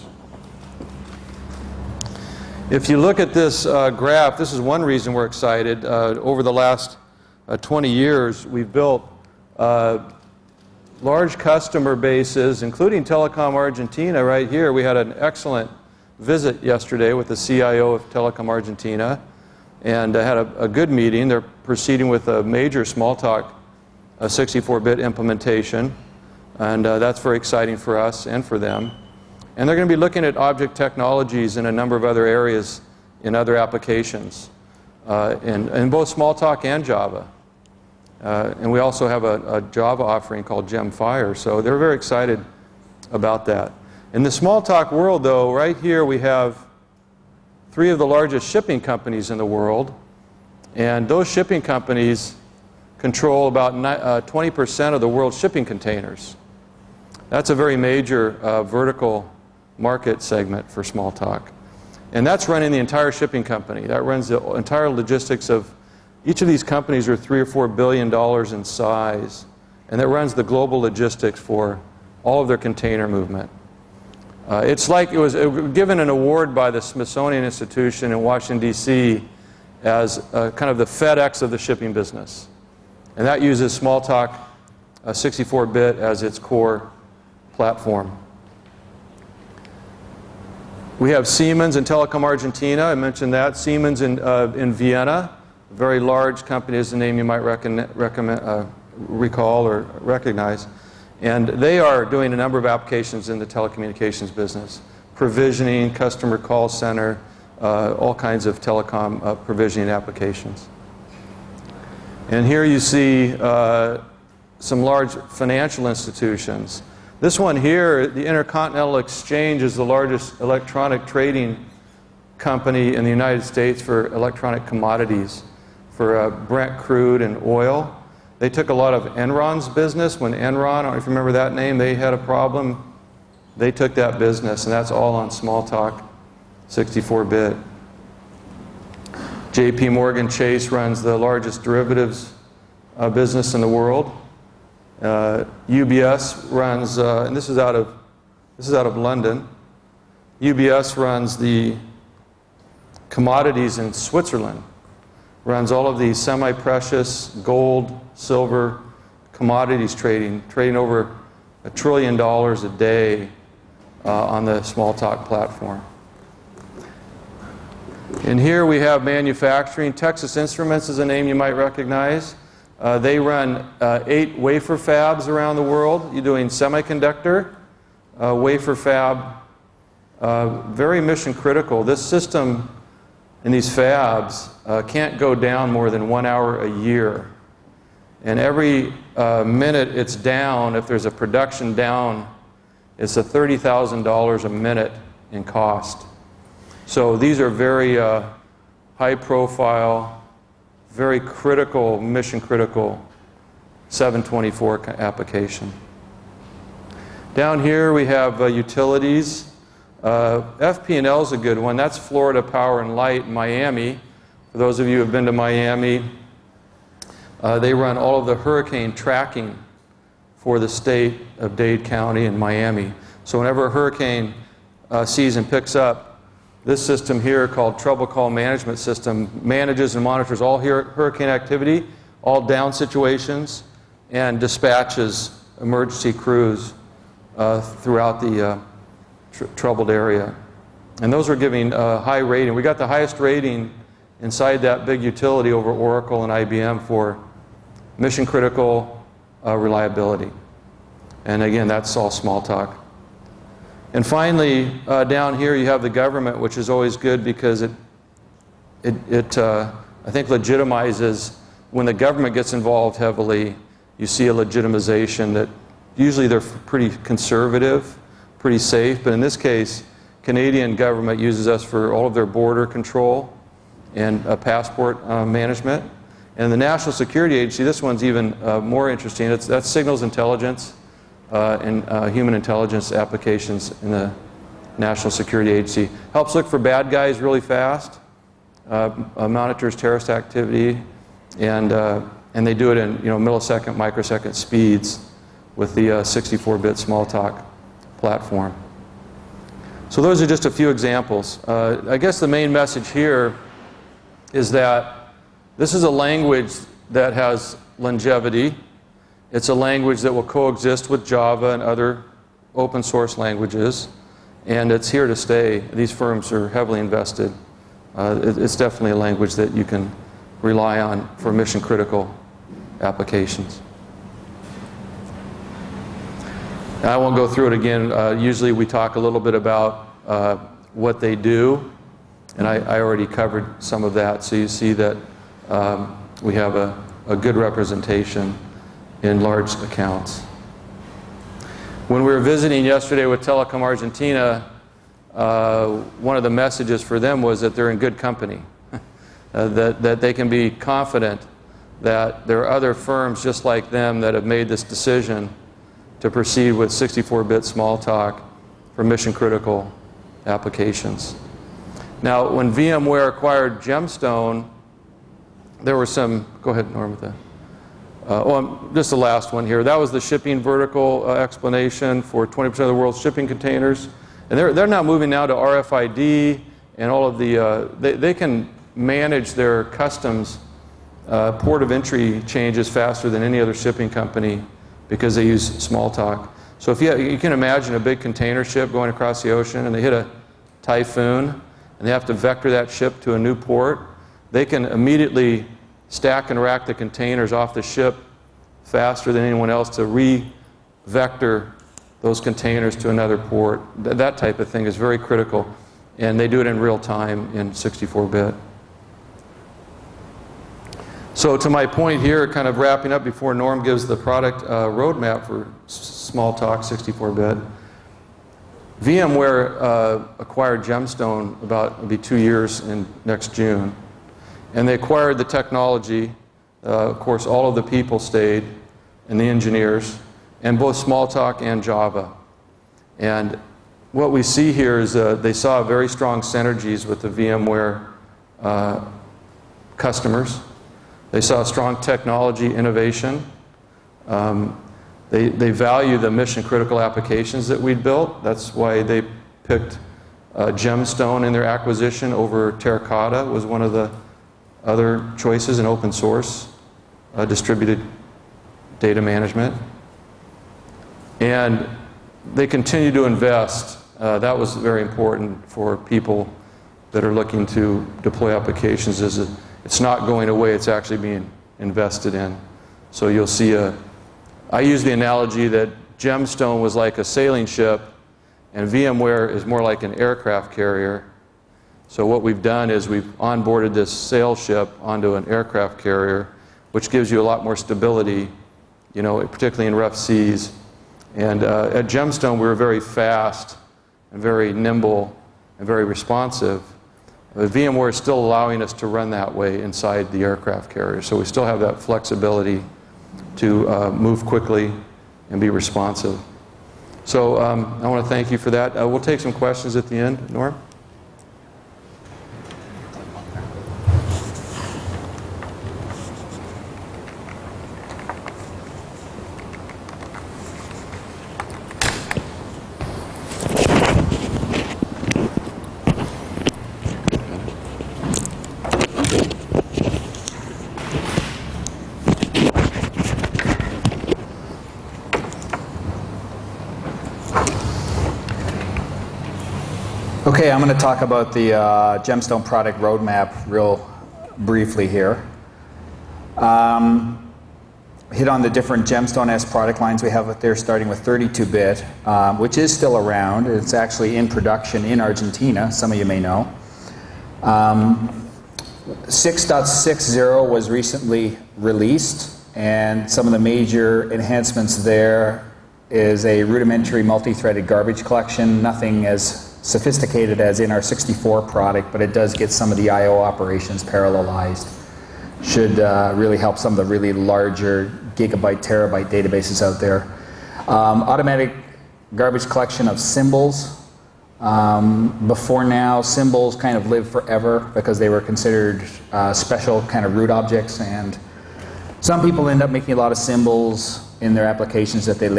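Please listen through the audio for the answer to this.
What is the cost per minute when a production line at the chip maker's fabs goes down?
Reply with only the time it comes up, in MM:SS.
03:13.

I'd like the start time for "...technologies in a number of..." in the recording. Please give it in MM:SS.
00:30.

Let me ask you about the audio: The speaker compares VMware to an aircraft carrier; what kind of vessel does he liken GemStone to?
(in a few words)
sailing ship.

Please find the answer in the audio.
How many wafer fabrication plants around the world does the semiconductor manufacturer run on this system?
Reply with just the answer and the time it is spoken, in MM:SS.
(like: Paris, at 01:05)
8, at 02:54.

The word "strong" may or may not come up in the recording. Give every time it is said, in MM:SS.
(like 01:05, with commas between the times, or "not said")
07:15, 07:21.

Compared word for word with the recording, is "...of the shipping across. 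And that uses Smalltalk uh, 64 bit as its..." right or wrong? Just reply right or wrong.
wrong.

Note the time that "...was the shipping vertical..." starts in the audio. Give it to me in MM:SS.
06:09.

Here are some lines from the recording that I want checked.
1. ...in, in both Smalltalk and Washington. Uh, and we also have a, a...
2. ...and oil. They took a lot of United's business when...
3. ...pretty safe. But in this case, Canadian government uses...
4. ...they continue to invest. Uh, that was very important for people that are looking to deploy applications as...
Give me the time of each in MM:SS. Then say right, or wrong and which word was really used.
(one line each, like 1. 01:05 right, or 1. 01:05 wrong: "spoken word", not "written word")
1. 00:35 wrong: "Java", not "Washington"
2. 02:07 wrong: "Enron", not "United"
3. 04:28 right
4. 07:42 right.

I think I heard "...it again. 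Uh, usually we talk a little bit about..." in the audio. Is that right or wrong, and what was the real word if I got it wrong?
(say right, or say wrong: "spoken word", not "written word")
right.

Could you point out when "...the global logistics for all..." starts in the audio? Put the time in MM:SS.
01:10.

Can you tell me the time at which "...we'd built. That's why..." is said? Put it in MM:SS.
07:27.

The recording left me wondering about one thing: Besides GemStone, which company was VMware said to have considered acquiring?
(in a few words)
Terracotta.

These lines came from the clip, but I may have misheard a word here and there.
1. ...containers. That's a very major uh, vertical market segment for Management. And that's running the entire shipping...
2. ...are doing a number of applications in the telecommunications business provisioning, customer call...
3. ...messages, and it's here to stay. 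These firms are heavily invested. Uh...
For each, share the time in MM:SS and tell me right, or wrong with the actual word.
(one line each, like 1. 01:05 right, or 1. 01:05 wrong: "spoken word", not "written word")
1. 00:55 wrong: "Smalltalk", not "Management"
2. 01:41 right
3. 05:13 wrong: "languages", not "messages".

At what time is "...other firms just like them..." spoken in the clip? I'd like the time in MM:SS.
05:52.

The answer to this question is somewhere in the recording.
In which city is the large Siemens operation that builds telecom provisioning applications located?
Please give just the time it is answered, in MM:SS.
01:34.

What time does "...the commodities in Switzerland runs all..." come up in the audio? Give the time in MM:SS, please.
02:31.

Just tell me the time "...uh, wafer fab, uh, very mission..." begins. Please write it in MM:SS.
02:58.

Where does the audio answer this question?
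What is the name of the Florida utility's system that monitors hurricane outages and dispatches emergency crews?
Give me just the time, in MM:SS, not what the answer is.
03:47.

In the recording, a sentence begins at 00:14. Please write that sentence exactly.
We had an excellent visit yesterday with the CIO of Telecom Argentina and uh, had a, a, good meeting.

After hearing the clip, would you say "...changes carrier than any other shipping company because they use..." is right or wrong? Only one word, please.
wrong.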